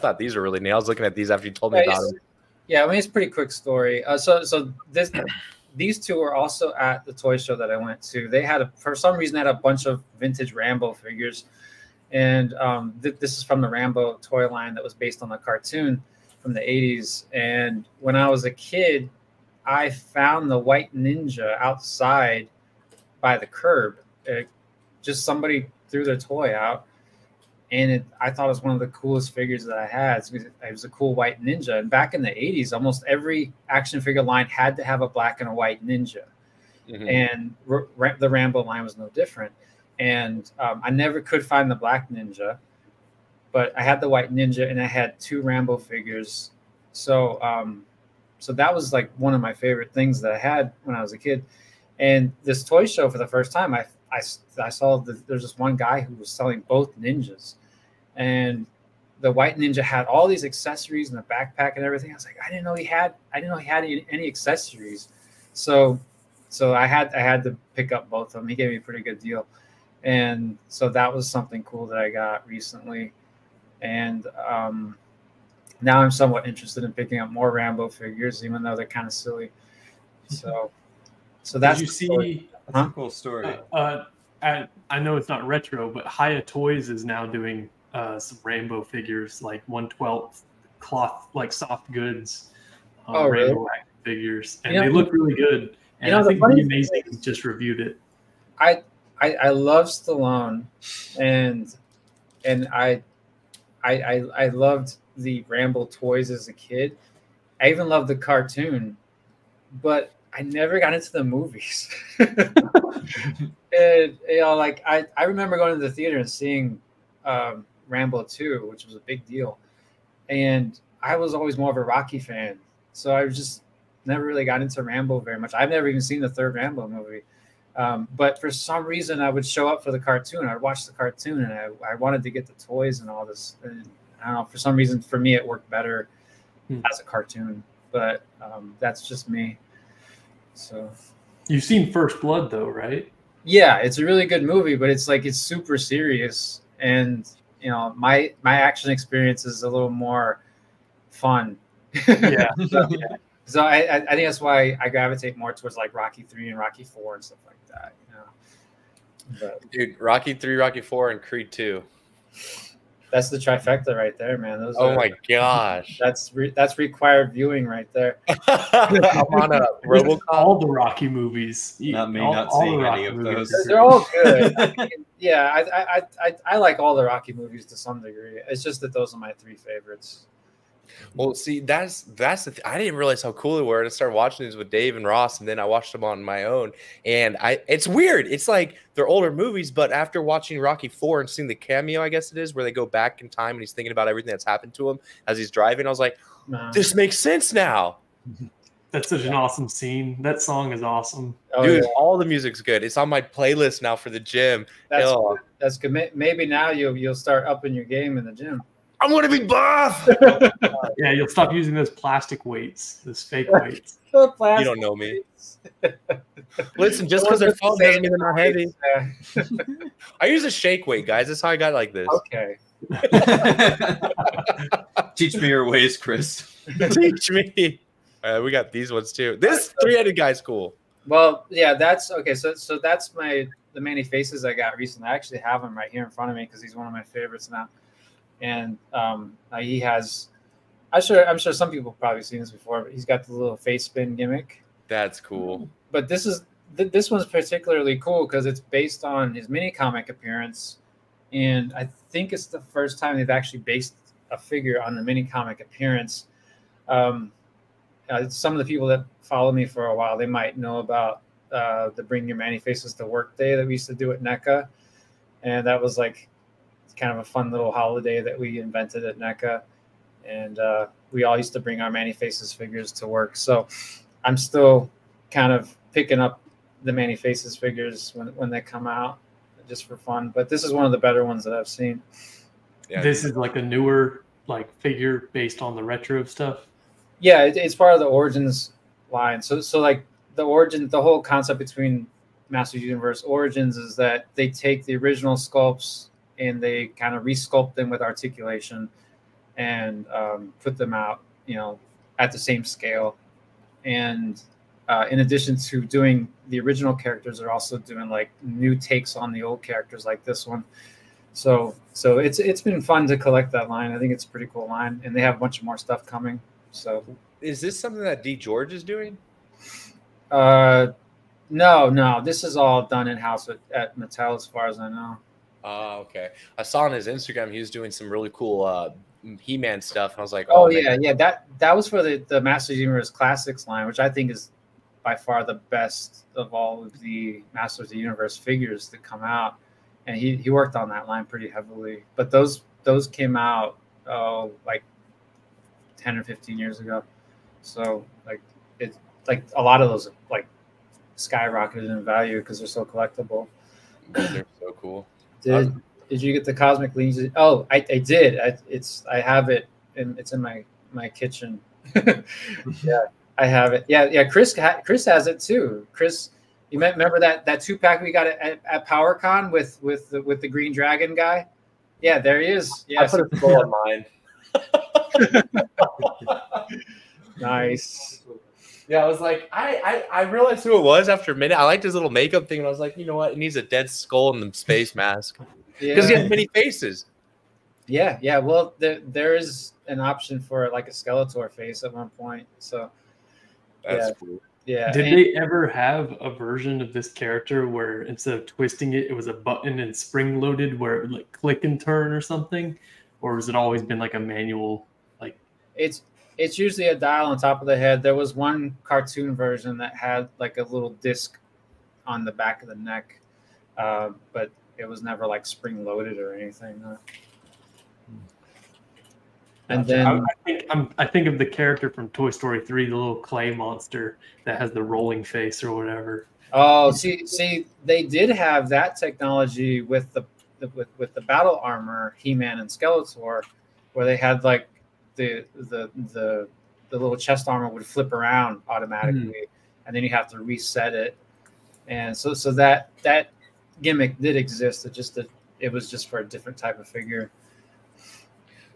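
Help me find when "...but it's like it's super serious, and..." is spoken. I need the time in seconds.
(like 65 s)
144 s.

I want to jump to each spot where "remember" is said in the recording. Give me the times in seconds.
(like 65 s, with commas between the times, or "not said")
115 s, 366 s.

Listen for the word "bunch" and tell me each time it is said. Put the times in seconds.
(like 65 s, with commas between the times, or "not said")
9 s, 315 s.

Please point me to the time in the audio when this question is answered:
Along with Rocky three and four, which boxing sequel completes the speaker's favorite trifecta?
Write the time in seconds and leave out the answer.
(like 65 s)
161 s.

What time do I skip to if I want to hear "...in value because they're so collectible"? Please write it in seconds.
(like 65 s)
351 s.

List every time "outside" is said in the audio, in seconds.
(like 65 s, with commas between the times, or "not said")
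21 s.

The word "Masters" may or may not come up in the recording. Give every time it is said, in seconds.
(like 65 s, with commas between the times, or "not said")
292 s, 332 s, 337 s.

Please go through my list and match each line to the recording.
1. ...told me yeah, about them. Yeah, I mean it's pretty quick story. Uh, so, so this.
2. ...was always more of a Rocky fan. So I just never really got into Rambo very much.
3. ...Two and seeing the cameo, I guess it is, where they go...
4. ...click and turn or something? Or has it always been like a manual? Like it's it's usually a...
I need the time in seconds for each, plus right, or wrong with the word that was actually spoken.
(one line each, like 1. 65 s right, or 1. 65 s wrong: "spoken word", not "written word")
1. 1 s right
2. 121 s right
3. 190 s wrong: "Four", not "Two"
4. 401 s right.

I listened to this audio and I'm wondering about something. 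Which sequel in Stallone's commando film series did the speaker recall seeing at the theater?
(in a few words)
Rambo 2.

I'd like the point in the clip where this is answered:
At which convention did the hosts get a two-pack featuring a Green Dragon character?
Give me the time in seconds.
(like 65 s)
368 s.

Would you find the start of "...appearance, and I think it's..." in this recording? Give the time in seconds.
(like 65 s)
250 s.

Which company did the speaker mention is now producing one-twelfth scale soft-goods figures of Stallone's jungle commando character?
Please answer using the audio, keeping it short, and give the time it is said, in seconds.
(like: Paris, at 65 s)
Hiya Toys, at 86 s.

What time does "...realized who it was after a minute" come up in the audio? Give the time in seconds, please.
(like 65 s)
380 s.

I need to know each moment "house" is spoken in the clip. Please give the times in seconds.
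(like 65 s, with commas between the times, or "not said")
323 s.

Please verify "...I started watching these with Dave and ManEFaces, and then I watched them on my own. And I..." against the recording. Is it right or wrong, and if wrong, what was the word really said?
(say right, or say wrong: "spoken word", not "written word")
wrong: "Ross", not "ManEFaces".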